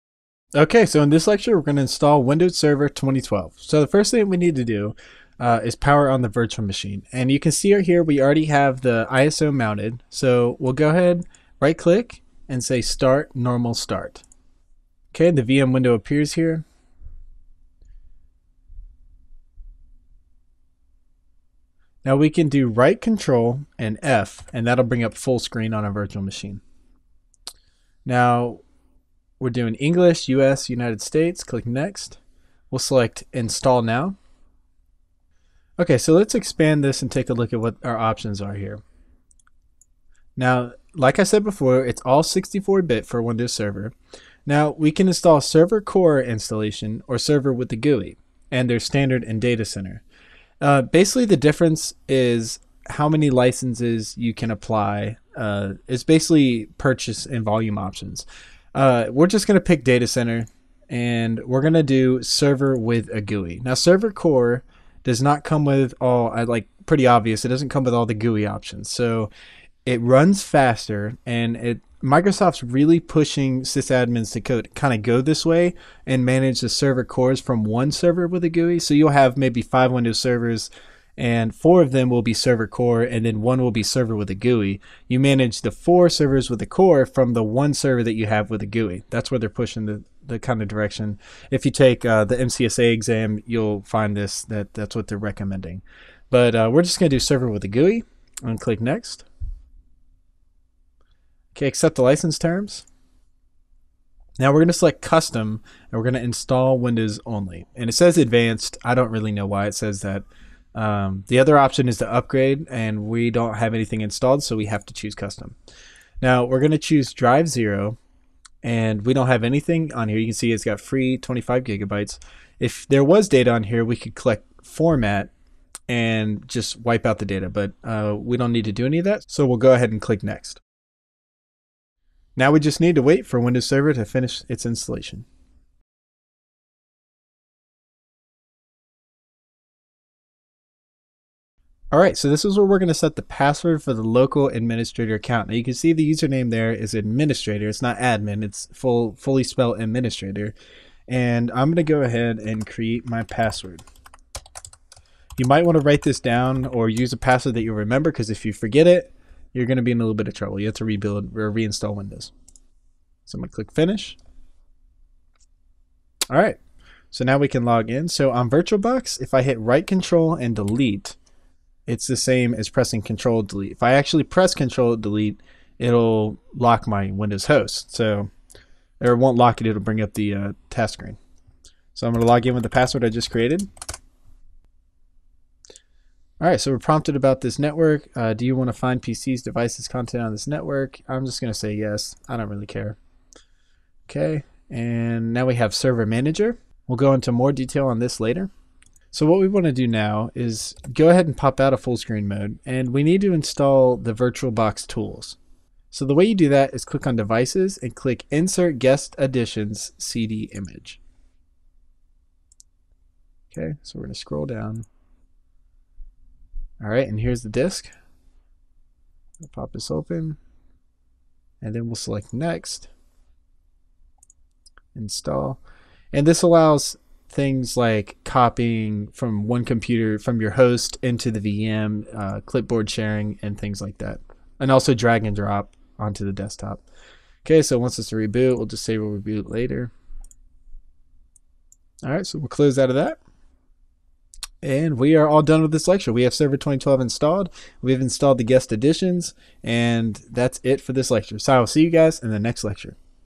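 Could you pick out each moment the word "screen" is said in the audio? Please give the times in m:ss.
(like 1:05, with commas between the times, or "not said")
0:25, 3:00, 3:21.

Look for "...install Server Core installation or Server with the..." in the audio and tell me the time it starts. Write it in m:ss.
0:45.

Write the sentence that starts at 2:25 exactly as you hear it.
Now you can see the username there is administrator.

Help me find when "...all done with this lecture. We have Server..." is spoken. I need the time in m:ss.
4:05.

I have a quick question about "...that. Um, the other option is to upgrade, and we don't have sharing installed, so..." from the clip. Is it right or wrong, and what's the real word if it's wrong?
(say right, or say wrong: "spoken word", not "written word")
wrong: "anything", not "sharing".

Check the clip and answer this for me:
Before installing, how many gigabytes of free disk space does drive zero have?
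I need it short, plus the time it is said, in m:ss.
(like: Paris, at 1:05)
25, at 2:01.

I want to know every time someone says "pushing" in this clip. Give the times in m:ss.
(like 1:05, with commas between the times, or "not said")
1:12, 1:29.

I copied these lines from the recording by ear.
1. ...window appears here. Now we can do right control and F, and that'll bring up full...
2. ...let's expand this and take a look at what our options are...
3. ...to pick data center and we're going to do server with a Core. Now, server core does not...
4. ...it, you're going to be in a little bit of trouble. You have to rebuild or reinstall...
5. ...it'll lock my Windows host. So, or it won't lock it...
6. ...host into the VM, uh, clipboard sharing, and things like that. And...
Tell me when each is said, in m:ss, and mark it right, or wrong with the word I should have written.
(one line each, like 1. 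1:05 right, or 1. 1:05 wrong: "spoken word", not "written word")
1. 0:15 right
2. 0:36 right
3. 0:59 wrong: "GUI", not "Core"
4. 2:38 right
5. 2:55 right
6. 3:50 right.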